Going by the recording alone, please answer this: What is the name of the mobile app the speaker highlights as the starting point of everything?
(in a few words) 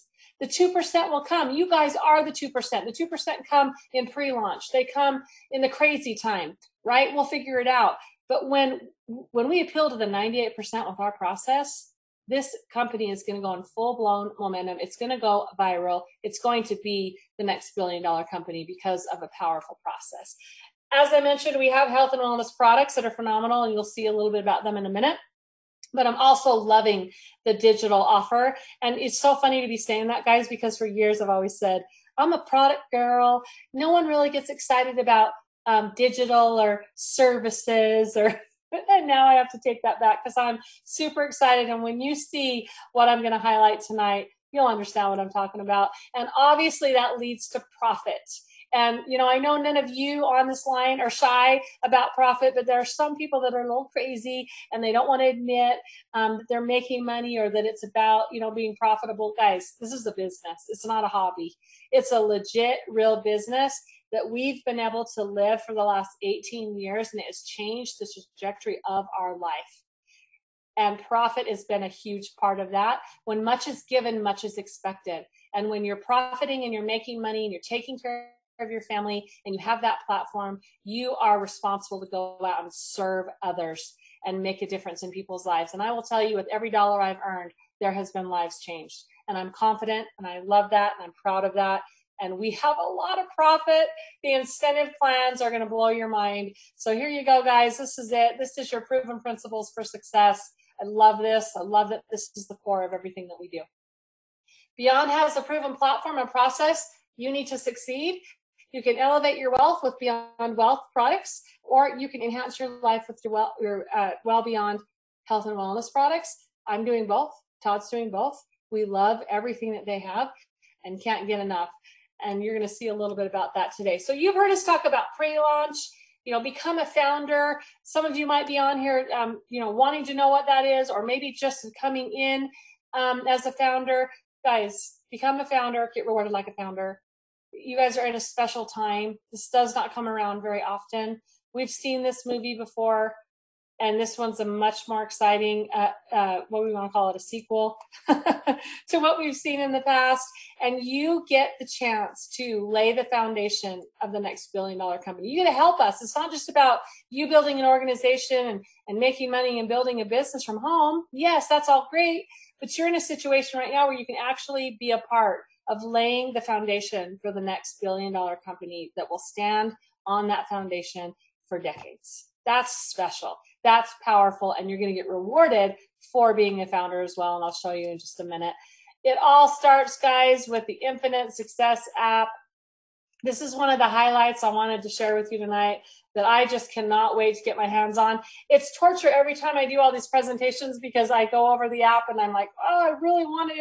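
Infinite Success app.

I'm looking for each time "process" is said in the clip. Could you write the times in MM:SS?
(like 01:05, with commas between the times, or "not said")
00:11, 00:19, 01:46.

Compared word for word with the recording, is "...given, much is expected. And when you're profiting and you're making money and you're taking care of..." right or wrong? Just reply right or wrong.
right.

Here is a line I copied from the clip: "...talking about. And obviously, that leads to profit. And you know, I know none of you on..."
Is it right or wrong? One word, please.
right.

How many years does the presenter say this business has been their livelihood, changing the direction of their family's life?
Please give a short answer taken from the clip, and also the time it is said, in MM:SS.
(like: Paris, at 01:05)
18, at 01:06.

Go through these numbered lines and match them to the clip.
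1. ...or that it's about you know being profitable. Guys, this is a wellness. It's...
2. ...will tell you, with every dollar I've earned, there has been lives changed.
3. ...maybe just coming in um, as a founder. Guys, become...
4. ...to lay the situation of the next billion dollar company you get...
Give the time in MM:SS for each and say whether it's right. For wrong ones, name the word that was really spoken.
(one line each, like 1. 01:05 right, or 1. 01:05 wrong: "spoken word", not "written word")
1. 00:57 wrong: "business", not "wellness"
2. 01:25 right
3. 02:11 right
4. 02:32 wrong: "foundation", not "situation".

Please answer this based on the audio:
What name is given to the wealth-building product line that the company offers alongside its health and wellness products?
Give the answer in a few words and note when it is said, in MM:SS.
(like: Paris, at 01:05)
Beyond Wealth, at 01:49.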